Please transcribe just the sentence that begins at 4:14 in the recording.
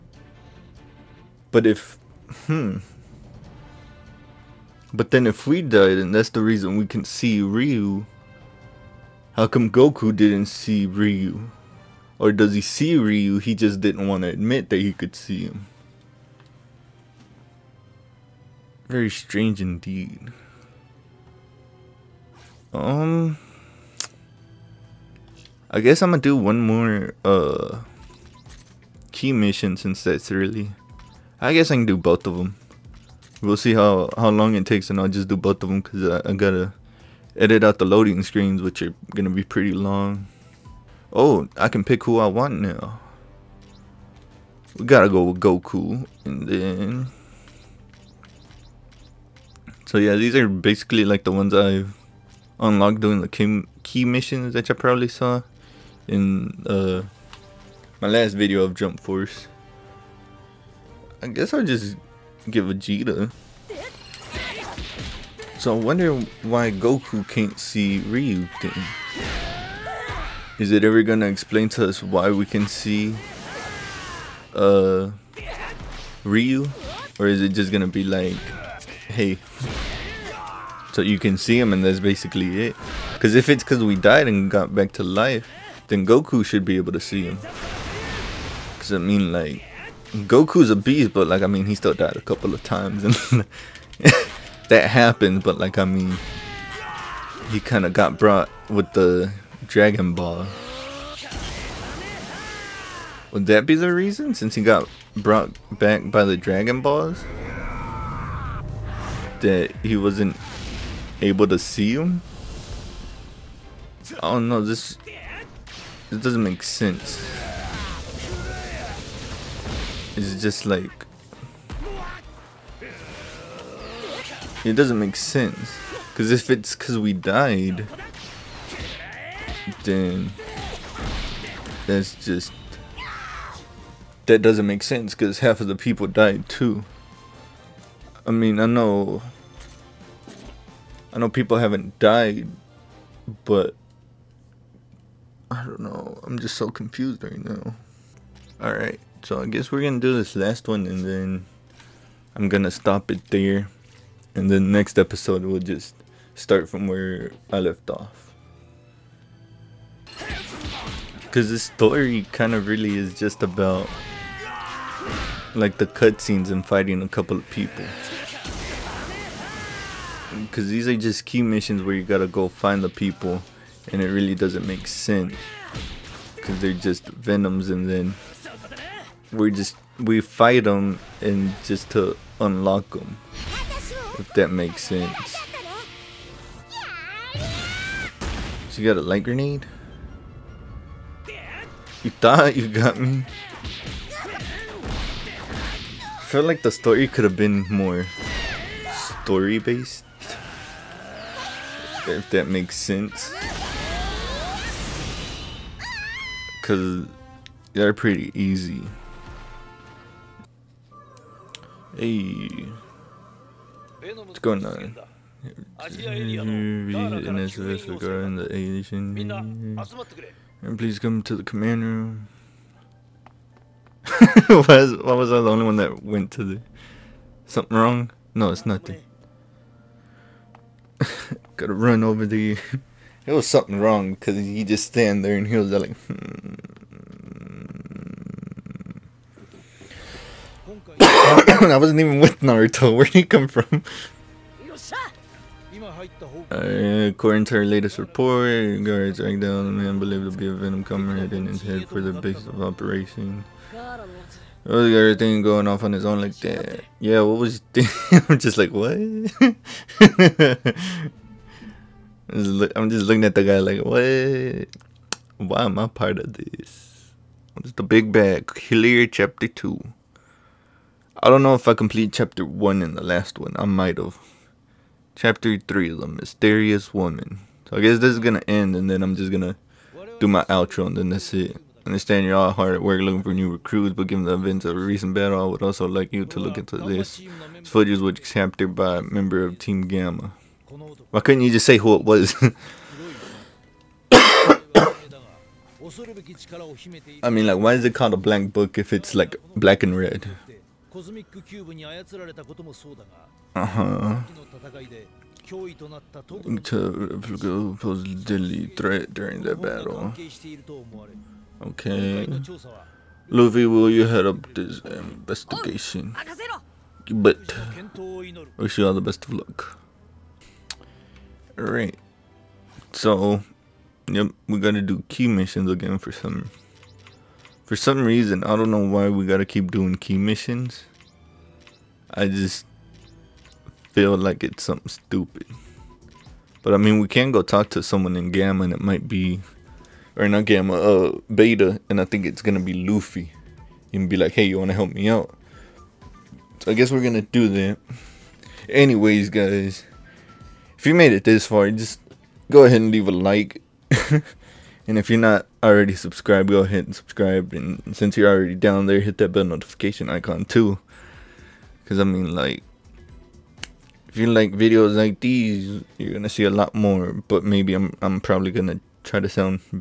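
Oh, the going off on his own like that.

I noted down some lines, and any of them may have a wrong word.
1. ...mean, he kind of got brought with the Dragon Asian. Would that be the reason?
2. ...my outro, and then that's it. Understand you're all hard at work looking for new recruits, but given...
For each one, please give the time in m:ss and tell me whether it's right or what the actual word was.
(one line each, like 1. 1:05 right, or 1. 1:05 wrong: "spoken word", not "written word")
1. 1:35 wrong: "Ball", not "Asian"
2. 4:40 right.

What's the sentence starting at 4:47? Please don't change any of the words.
This footage was chapter by a member of Team Gamma.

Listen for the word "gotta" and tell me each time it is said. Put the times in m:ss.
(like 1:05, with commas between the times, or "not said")
0:36, 0:44, 2:52, 5:24, 5:29.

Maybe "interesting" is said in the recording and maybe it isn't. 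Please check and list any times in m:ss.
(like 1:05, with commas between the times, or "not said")
not said.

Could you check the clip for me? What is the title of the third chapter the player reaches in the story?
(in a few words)
The Mysterious Woman.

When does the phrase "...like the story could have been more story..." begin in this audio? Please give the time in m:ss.
3:16.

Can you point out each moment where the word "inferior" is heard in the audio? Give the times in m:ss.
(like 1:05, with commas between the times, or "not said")
not said.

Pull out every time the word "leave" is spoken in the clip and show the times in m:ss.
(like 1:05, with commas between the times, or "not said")
5:52.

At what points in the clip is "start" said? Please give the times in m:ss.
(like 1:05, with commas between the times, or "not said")
2:36.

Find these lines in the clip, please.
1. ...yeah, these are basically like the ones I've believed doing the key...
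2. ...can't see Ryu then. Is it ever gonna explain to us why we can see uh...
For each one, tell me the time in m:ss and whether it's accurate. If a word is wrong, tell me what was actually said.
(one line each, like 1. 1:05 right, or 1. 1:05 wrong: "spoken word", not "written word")
1. 0:49 wrong: "unlocked", not "believed"
2. 1:07 right.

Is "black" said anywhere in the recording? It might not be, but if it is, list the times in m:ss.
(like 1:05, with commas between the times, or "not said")
4:59.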